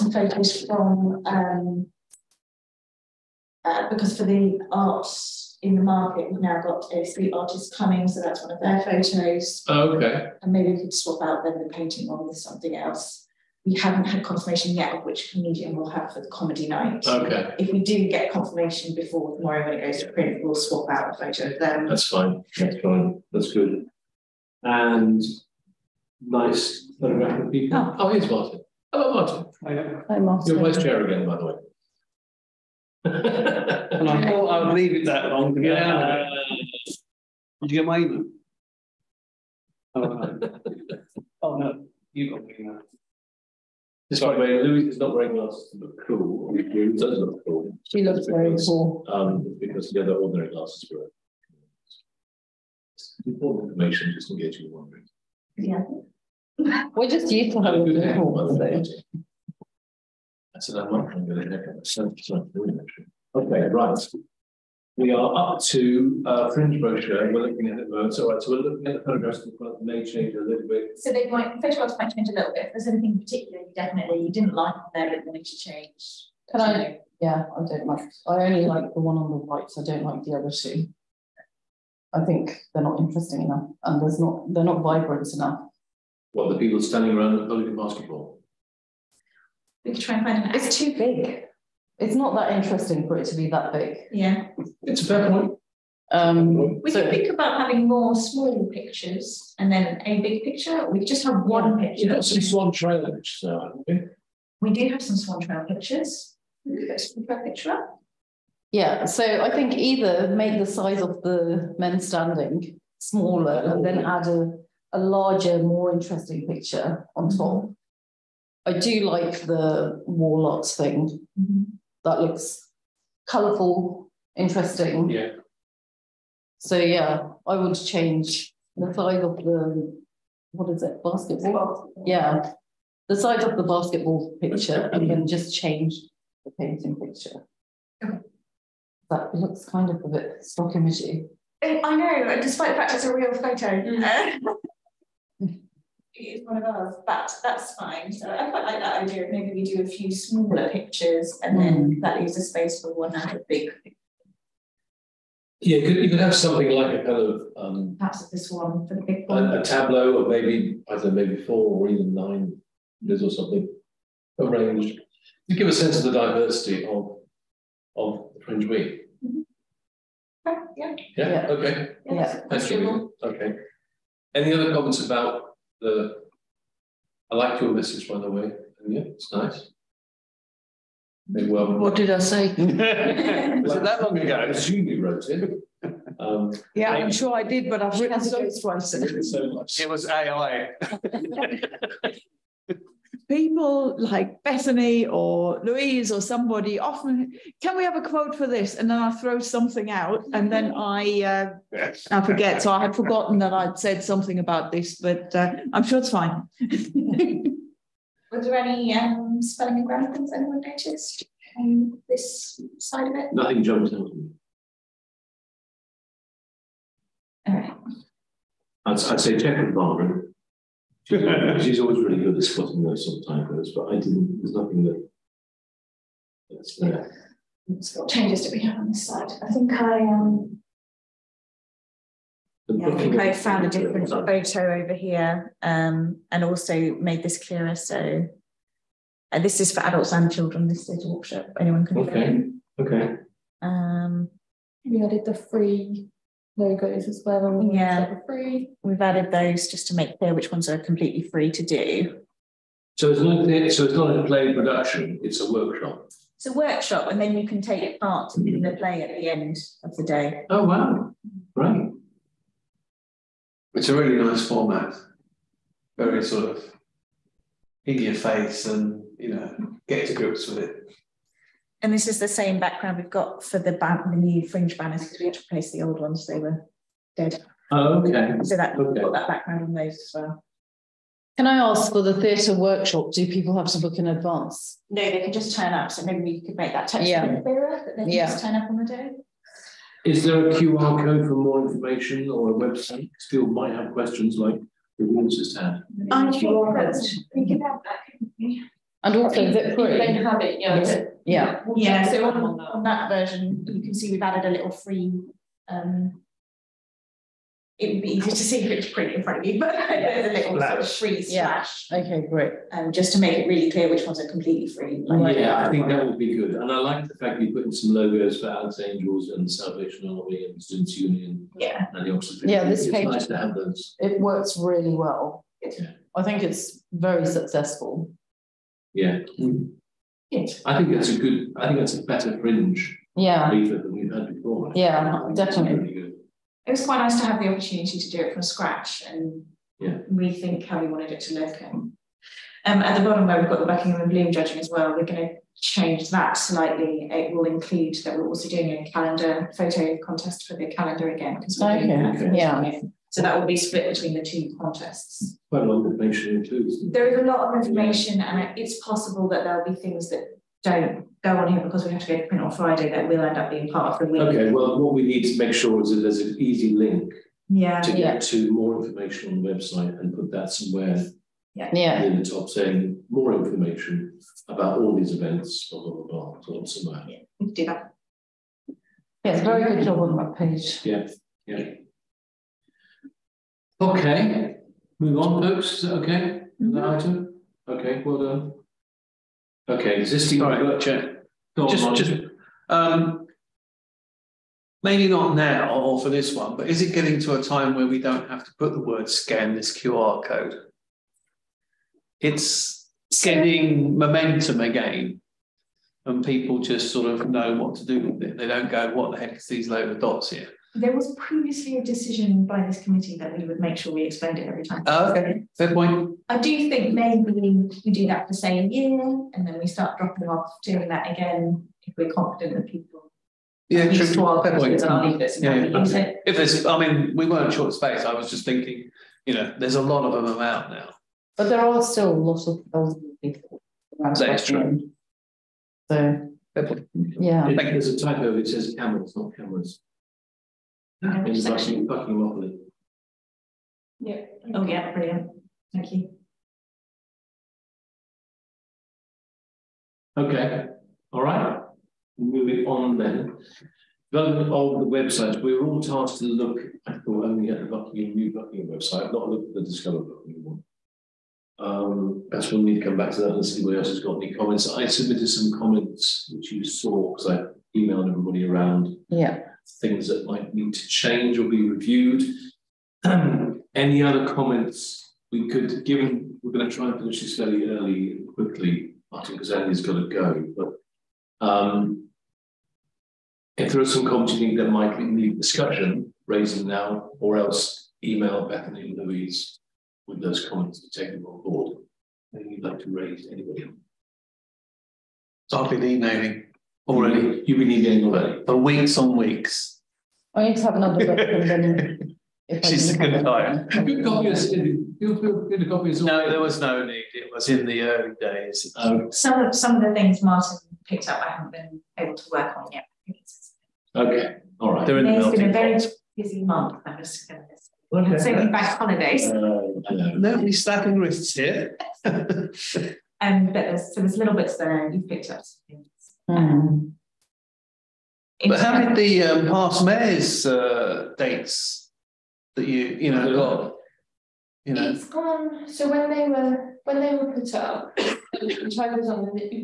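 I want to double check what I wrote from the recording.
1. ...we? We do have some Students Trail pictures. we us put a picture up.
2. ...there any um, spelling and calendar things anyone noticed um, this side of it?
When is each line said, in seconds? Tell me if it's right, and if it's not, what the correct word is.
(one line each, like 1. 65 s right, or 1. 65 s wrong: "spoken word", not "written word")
1. 103 s wrong: "Swan", not "Students"
2. 208 s wrong: "grammar", not "calendar".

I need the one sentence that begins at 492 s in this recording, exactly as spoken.
Anything you'd like to raise, anybody?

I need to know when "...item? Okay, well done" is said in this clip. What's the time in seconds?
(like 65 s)
386 s.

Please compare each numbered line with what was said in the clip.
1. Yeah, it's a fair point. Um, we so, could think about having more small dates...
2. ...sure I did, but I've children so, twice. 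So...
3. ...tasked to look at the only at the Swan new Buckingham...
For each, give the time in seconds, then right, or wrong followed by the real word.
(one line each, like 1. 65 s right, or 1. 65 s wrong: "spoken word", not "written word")
1. 94 s wrong: "pictures", not "dates"
2. 187 s wrong: "written", not "children"
3. 455 s wrong: "Buckingham", not "Swan".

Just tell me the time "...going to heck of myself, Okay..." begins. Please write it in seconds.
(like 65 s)
61 s.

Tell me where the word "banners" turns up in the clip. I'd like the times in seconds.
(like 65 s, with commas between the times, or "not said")
274 s.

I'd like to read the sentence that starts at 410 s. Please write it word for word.
There was previously a decision by this committee that we would make sure we explained it every time.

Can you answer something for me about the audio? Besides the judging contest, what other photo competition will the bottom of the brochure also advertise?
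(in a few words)
A calendar photo contest.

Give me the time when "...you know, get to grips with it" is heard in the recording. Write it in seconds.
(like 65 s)
269 s.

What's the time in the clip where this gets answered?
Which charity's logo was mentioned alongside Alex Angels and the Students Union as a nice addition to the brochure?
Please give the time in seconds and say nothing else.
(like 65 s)
319 s.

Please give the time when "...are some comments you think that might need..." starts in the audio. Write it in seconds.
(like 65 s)
483 s.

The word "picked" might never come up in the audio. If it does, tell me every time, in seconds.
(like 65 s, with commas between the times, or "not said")
510 s, 525 s.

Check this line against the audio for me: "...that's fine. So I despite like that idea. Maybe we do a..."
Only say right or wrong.
wrong.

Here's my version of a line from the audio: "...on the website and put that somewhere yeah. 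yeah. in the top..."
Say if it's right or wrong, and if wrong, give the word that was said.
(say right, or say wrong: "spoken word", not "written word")
right.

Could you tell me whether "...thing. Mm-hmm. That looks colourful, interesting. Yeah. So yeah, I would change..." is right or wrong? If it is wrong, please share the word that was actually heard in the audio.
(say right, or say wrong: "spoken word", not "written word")
right.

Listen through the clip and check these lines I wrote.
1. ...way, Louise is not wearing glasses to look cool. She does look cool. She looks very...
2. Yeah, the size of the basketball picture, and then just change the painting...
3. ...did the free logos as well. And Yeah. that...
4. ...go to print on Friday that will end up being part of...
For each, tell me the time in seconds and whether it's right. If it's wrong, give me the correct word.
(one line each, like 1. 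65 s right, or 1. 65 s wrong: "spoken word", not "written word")
1. 44 s right
2. 132 s right
3. 245 s right
4. 362 s right.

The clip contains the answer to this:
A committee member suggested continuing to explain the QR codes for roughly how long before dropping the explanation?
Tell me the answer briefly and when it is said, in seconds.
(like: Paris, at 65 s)
A year, at 418 s.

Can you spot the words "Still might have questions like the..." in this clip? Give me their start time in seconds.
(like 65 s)
293 s.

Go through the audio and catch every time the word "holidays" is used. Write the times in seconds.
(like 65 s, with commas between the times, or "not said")
518 s.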